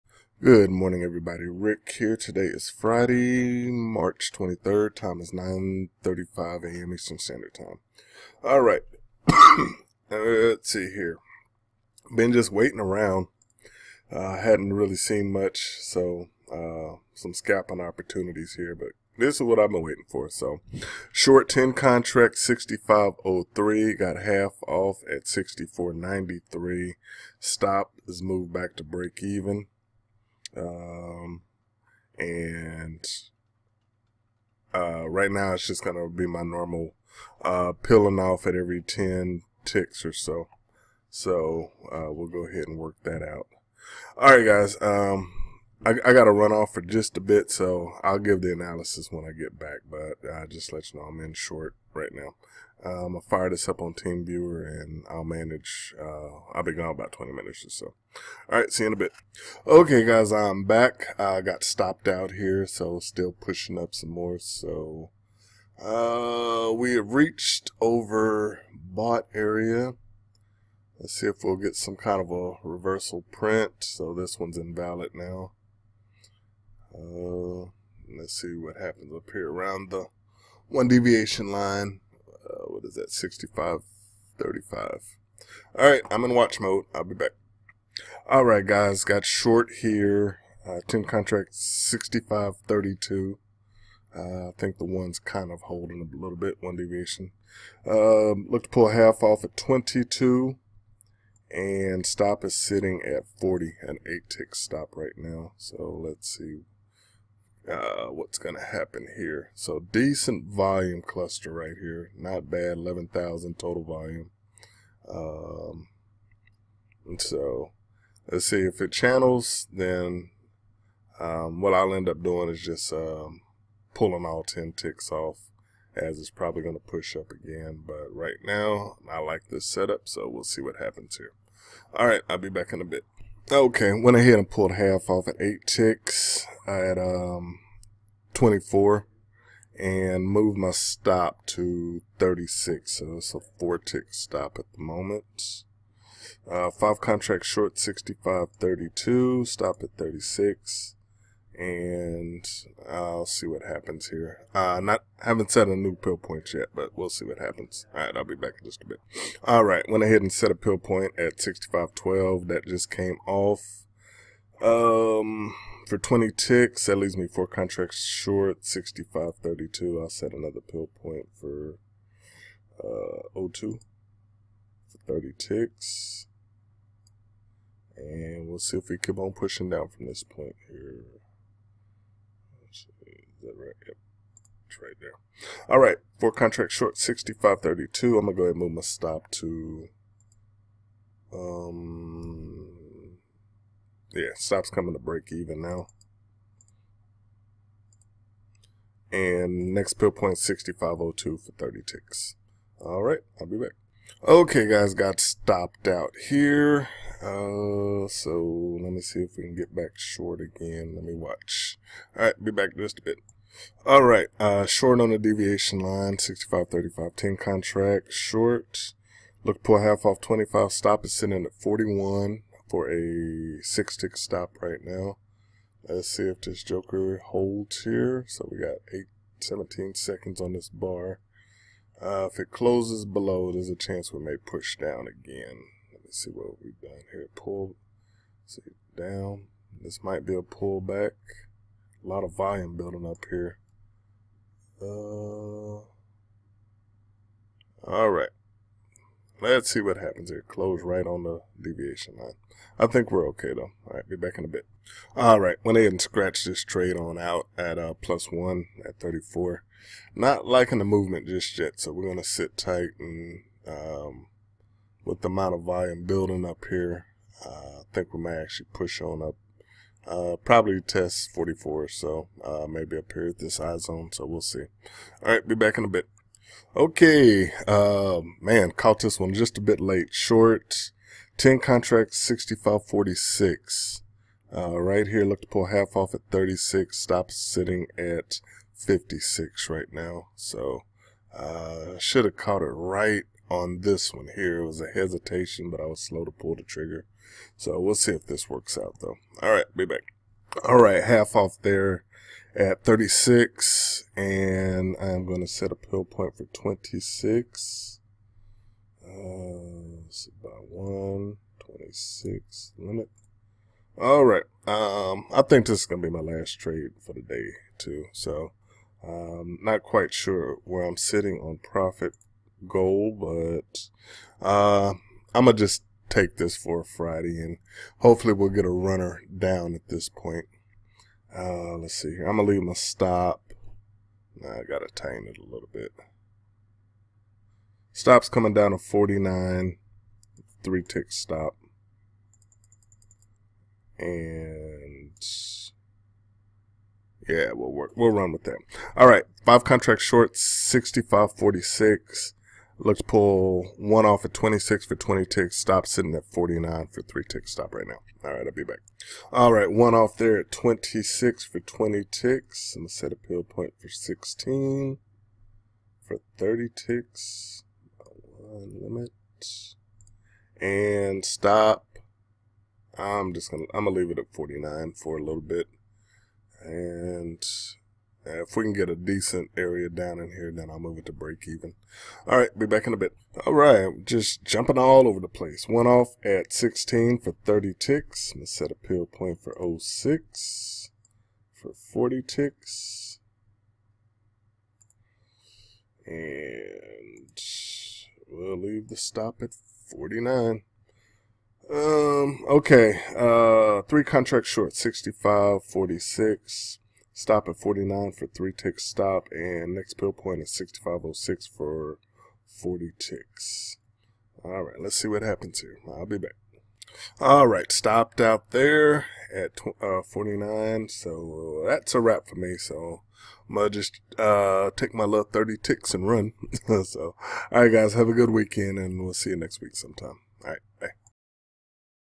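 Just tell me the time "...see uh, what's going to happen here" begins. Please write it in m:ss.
1:46.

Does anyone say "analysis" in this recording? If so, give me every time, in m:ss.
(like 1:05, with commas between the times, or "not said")
0:48.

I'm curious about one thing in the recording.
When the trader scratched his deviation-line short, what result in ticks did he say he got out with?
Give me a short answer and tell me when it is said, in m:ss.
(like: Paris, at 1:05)
plus one, at 4:18.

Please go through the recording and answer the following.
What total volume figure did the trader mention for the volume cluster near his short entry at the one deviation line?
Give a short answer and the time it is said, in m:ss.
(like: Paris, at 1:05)
11,000, at 1:52.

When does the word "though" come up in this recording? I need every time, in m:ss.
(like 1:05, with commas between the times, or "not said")
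4:13, 4:59.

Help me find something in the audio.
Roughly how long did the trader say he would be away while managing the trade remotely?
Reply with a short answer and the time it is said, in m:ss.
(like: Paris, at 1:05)
20 minutes, at 0:57.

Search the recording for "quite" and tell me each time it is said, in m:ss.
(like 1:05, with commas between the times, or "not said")
5:19.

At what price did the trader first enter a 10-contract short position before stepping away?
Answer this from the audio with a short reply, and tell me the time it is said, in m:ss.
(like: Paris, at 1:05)
6503, at 0:22.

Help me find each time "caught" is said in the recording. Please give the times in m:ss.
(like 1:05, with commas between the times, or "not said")
4:38, 4:52.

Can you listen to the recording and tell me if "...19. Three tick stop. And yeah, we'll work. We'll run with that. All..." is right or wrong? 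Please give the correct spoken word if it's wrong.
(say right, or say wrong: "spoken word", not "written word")
wrong: "49", not "19".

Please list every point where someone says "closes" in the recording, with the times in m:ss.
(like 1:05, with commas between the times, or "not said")
3:52, 4:10.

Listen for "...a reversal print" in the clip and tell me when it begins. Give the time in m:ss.
1:12.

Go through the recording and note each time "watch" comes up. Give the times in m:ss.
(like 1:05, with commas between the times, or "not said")
1:26, 3:31.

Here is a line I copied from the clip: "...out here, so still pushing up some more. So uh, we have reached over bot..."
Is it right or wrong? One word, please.
right.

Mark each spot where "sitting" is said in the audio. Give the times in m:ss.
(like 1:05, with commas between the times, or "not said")
1:42, 3:41, 4:47, 5:20, 5:55.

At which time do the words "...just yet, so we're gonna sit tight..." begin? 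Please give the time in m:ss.
4:21.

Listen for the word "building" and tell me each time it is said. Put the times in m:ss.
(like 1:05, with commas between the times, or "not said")
4:02, 4:26.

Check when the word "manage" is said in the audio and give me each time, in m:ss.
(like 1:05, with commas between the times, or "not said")
0:55.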